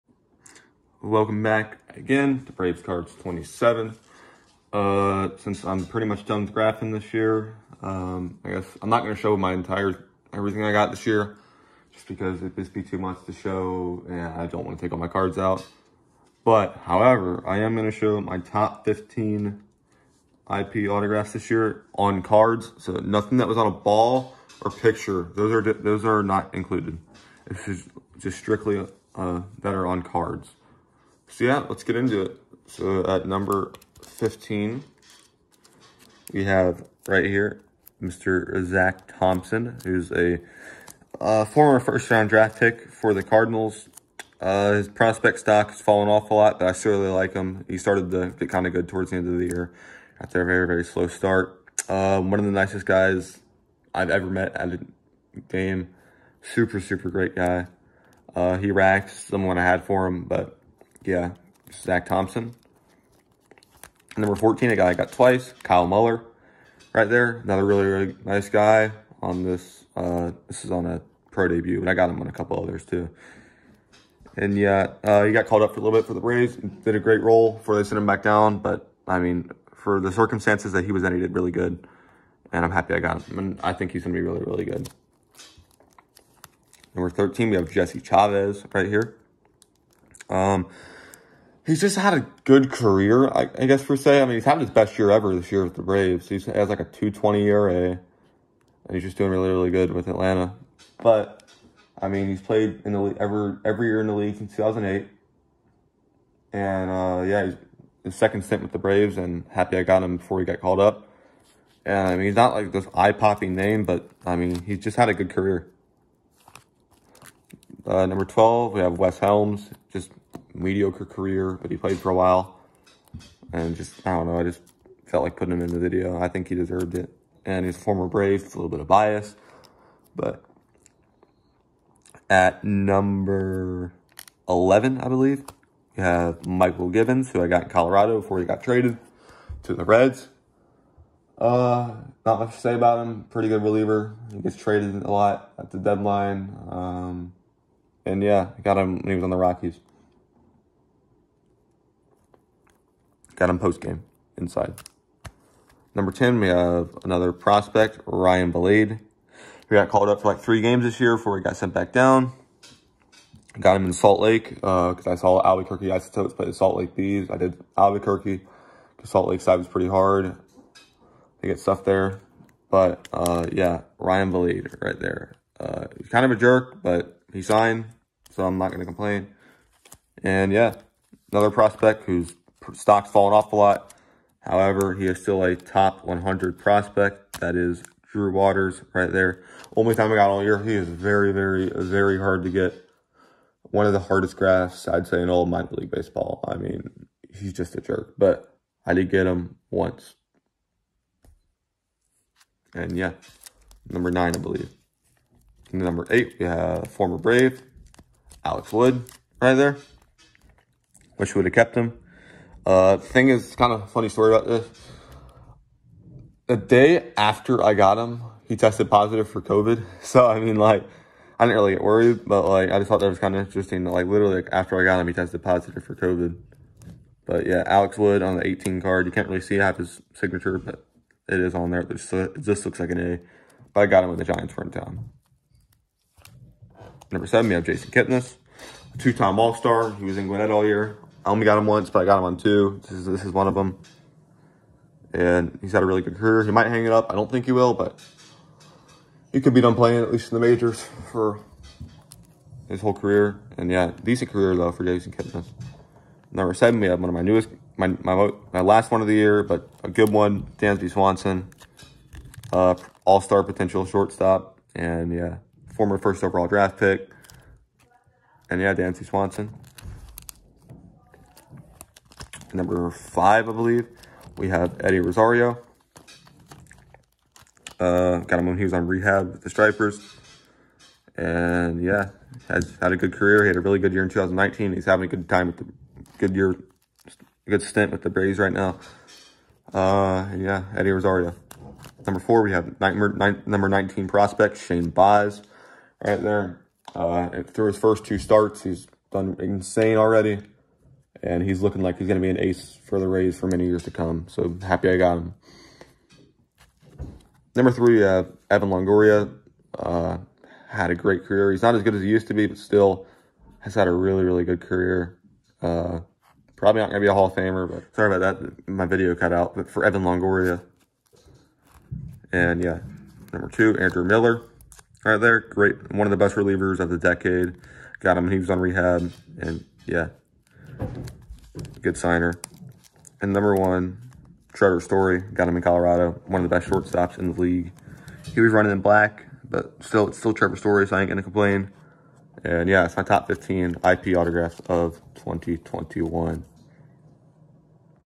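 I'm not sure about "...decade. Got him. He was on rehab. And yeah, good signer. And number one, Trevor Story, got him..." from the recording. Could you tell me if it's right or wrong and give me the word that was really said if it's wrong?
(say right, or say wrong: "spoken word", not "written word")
right.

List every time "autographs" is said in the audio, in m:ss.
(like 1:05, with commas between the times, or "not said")
0:20, 5:44.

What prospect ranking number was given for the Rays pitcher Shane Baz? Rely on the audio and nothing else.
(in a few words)
19.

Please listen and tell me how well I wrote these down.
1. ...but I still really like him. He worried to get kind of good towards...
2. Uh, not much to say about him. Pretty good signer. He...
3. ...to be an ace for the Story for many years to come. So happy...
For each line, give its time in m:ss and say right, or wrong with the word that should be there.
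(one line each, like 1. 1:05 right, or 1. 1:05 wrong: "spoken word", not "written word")
1. 0:46 wrong: "started", not "worried"
2. 2:21 wrong: "reliever", not "signer"
3. 5:02 wrong: "Rays", not "Story".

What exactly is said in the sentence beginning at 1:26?
Number 13, we have Jesse Chavez right here.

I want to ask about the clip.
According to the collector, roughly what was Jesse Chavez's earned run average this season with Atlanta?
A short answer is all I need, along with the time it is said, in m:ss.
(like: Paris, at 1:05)
2.20, at 1:36.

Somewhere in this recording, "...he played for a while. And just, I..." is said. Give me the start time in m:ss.
2:01.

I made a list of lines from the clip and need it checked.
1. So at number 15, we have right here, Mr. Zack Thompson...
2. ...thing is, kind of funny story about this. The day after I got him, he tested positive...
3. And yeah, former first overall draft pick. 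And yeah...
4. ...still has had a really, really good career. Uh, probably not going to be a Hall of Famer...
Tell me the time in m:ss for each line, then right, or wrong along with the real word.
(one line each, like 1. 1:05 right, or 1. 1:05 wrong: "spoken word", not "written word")
1. 0:32 right
2. 3:32 right
3. 4:24 right
4. 5:12 right.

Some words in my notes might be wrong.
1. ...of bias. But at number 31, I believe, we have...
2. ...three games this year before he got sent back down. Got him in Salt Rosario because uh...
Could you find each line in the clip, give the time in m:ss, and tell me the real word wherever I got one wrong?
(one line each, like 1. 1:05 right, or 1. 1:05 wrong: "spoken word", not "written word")
1. 2:08 wrong: "11", not "31"
2. 2:40 wrong: "Lake", not "Rosario".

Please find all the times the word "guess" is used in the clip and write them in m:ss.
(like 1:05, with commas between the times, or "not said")
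0:08, 1:33.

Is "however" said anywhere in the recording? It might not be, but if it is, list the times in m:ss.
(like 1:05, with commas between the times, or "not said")
0:16, 3:04.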